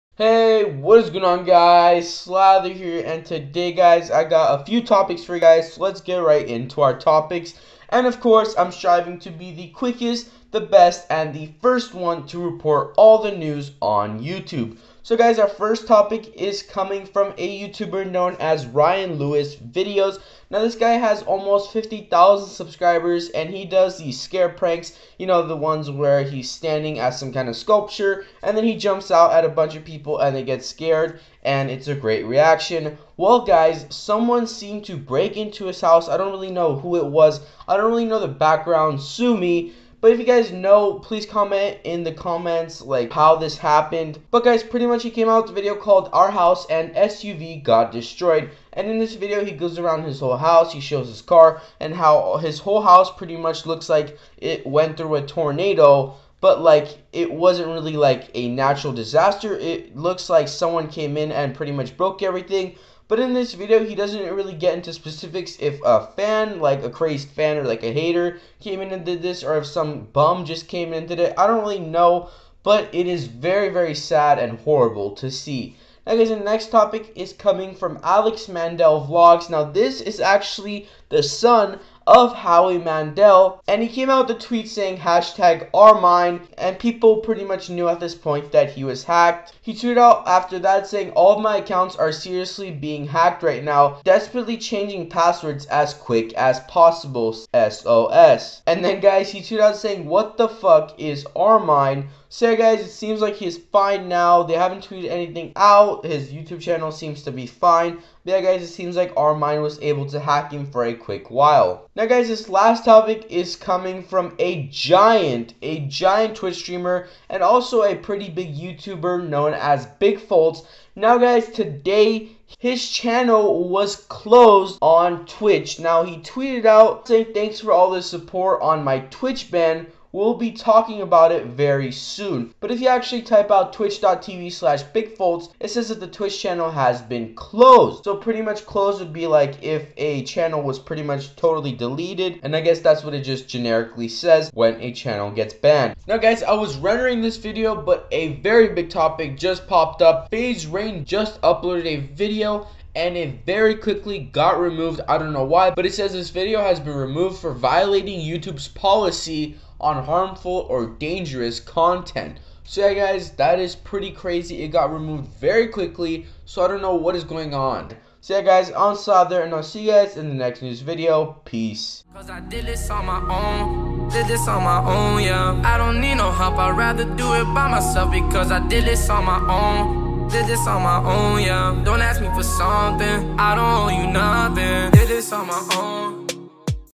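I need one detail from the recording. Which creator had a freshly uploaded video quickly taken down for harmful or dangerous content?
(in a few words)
FaZe Rain.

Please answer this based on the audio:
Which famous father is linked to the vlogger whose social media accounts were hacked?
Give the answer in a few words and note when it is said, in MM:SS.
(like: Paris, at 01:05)
Howie Mandel, at 01:22.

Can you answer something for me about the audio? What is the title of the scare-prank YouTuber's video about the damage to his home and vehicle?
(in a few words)
Our House and SUV Got Destroyed.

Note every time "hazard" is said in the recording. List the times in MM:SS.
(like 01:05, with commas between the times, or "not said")
not said.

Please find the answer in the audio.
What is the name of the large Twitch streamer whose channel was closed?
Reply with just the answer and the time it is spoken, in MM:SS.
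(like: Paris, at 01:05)
Big Foltz, at 01:59.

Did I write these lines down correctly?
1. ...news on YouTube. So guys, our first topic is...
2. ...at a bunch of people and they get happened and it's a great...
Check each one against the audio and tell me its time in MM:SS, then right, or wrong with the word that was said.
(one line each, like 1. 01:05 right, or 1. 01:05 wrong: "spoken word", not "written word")
1. 00:13 right
2. 00:29 wrong: "scared", not "happened".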